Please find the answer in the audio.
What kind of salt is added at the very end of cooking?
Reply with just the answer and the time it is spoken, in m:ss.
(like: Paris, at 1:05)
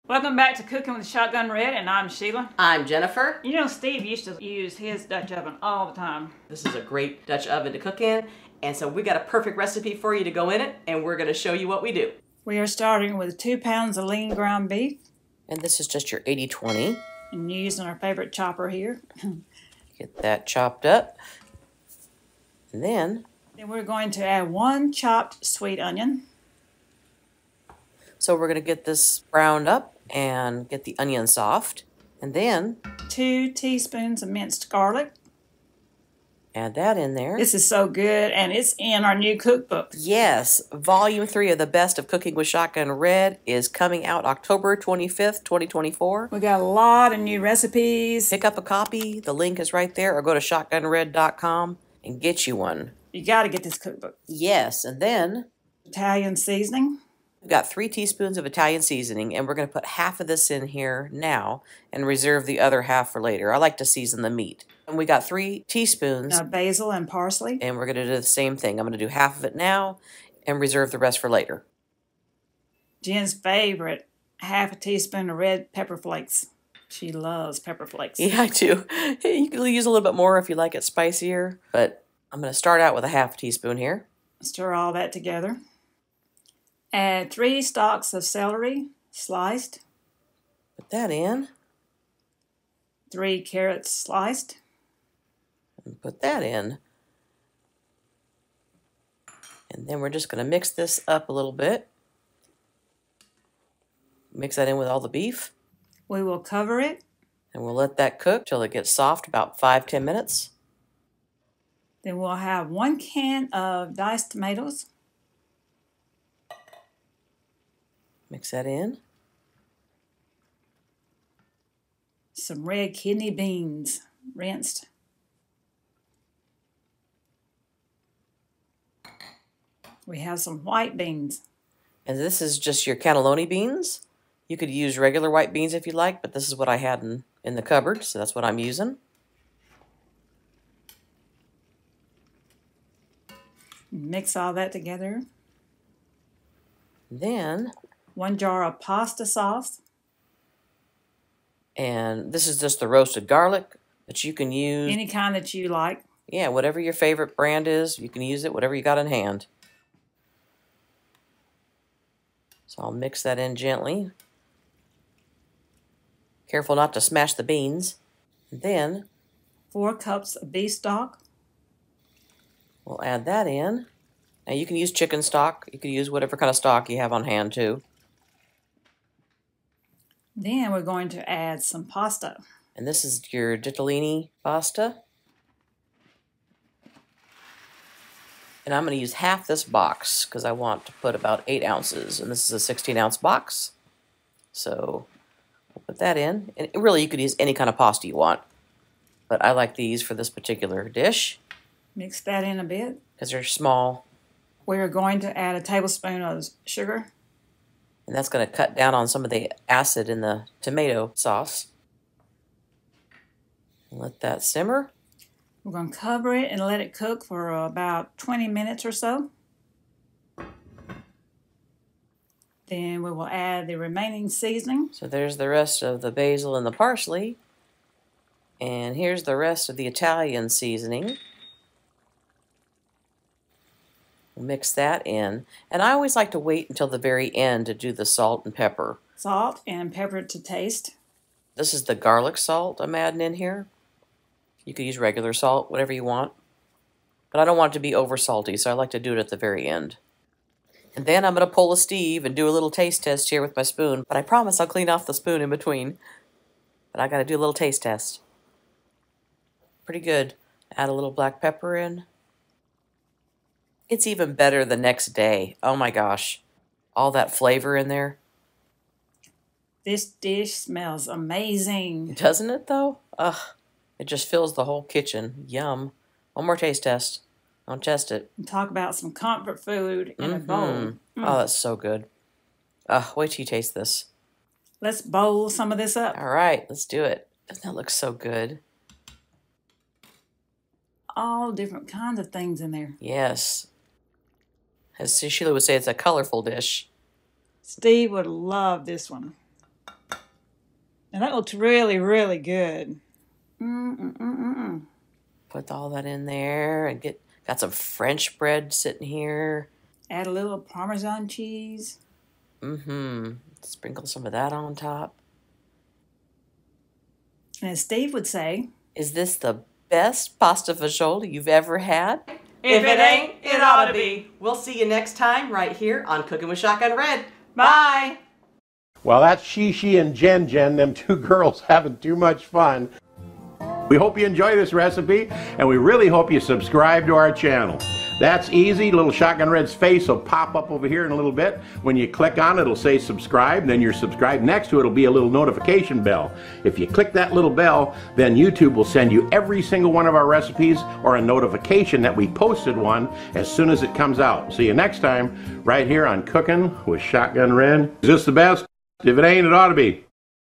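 garlic salt, at 4:01.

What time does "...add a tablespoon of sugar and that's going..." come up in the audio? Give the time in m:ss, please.
3:25.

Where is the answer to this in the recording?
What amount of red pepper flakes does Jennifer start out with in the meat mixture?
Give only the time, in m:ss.
1:14.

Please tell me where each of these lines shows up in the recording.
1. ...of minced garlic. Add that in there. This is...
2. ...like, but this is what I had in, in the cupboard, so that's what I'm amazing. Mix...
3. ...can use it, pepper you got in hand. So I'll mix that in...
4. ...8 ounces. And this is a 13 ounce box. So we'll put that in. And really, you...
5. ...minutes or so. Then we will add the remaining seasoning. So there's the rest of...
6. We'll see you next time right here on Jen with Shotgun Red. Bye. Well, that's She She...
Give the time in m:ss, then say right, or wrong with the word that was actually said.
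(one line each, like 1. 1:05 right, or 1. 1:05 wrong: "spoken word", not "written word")
1. 0:34 right
2. 2:15 wrong: "using", not "amazing"
3. 2:38 wrong: "whatever", not "pepper"
4. 3:11 wrong: "16", not "13"
5. 3:38 right
6. 5:24 wrong: "Cooking", not "Jen".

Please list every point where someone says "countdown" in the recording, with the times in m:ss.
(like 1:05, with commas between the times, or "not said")
not said.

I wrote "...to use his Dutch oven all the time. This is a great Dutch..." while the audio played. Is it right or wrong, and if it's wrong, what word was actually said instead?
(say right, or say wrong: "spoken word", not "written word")
right.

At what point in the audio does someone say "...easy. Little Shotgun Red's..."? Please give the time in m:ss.
5:38.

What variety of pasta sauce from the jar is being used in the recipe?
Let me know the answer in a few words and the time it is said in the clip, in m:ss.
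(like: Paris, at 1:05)
roasted garlic, at 2:32.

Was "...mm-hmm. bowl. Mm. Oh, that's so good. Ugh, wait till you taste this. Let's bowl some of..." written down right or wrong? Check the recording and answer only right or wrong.
right.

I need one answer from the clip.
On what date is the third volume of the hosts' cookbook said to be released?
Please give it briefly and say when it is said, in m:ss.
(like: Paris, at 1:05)
October 25th, 2024, at 0:44.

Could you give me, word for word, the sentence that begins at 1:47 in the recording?
And we'll let that cook till it gets soft, about five ten minutes.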